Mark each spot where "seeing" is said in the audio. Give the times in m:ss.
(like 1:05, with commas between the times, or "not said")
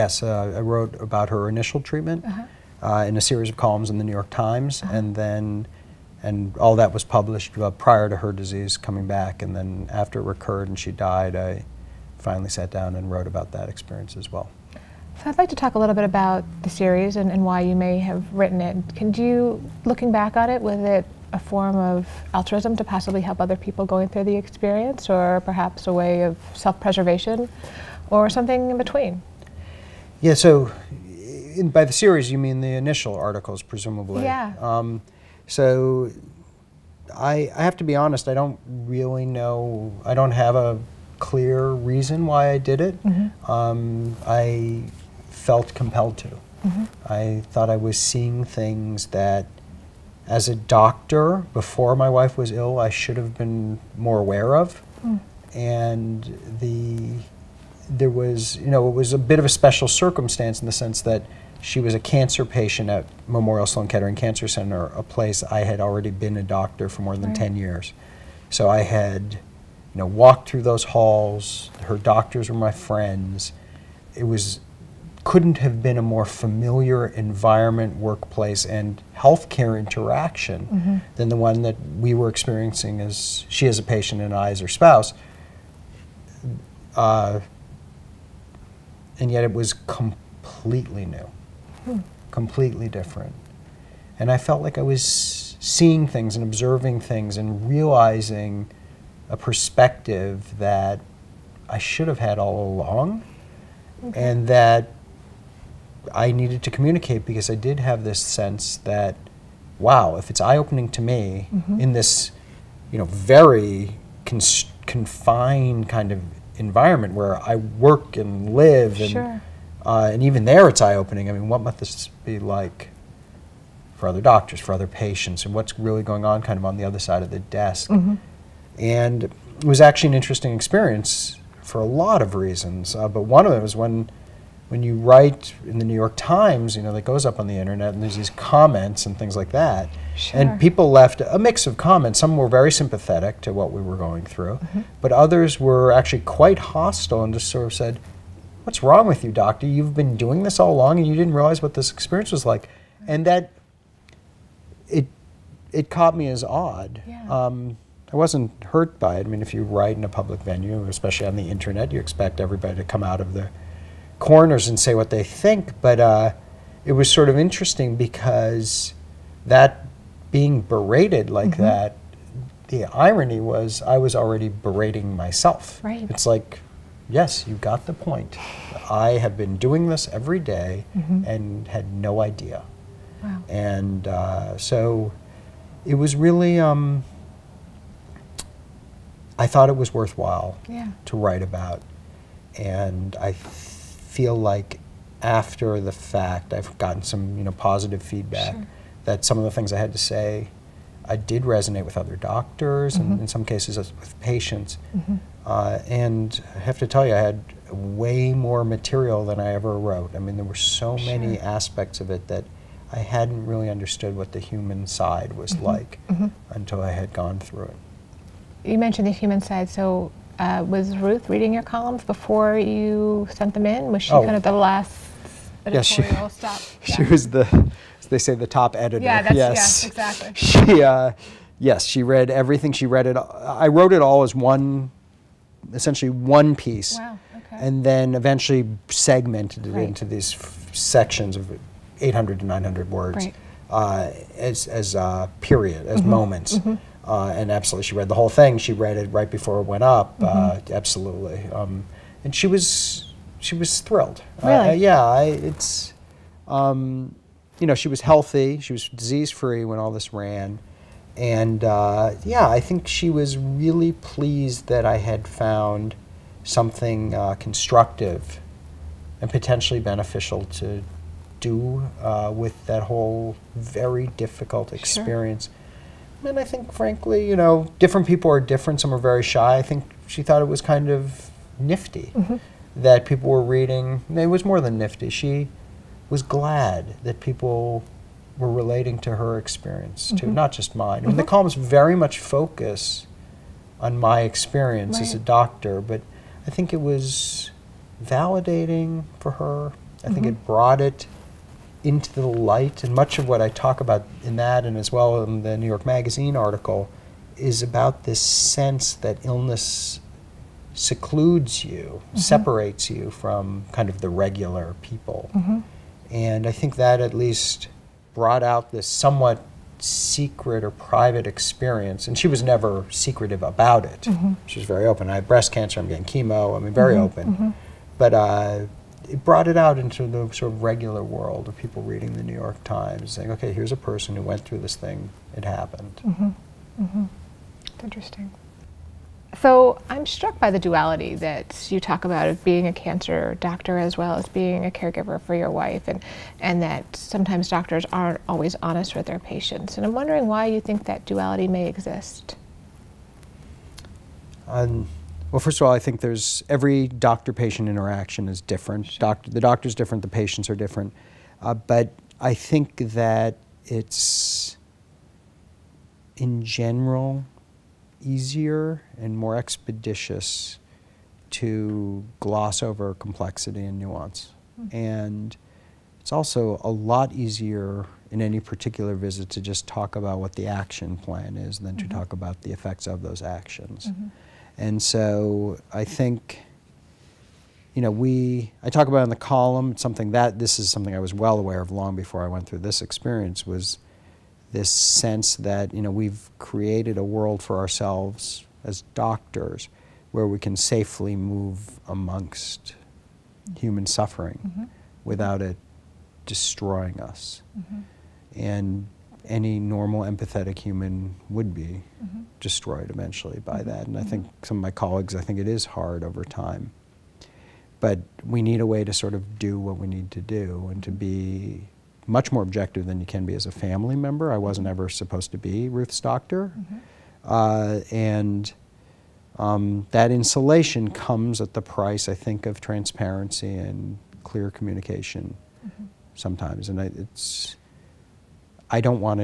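0:48, 1:35.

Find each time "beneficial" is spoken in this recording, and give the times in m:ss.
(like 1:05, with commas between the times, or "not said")
4:29.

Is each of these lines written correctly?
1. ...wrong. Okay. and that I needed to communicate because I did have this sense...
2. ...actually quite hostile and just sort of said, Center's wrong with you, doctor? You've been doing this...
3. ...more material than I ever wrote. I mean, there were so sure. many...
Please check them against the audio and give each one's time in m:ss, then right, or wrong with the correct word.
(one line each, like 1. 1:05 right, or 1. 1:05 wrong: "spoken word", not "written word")
1. 1:42 wrong: "along", not "wrong"
2. 2:25 wrong: "What", not "Center"
3. 3:28 right.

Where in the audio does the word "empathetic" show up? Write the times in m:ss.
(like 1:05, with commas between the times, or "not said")
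6:50.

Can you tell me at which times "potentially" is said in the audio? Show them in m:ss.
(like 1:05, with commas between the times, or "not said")
4:29.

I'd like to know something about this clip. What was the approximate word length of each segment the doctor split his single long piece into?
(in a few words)
800 to 900 words.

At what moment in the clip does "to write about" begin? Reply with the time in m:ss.
3:11.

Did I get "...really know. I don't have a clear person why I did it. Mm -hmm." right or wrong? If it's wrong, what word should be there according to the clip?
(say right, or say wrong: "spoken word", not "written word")
wrong: "reason", not "person".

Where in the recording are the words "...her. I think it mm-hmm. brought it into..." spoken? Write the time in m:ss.
4:59.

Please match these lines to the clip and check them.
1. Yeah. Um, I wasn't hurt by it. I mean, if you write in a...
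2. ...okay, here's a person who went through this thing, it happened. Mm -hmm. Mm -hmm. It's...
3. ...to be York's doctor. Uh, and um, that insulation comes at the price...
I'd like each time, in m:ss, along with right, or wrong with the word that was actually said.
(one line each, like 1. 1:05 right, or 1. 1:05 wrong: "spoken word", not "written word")
1. 2:37 right
2. 5:33 right
3. 7:05 wrong: "Ruth", not "York".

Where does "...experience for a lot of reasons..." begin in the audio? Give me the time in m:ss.
2:10.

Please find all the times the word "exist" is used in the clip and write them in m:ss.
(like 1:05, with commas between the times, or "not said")
5:51.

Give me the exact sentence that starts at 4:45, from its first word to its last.
She was glad that people were relating to her experience too, mm -hmm.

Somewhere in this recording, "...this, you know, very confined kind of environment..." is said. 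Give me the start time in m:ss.
1:51.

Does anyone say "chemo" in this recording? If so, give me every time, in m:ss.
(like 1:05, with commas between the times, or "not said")
5:26.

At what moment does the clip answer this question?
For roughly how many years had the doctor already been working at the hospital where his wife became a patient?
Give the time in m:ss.
1:07.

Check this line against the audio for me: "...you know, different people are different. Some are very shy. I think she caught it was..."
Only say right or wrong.
wrong.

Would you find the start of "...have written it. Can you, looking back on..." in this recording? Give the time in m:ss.
0:17.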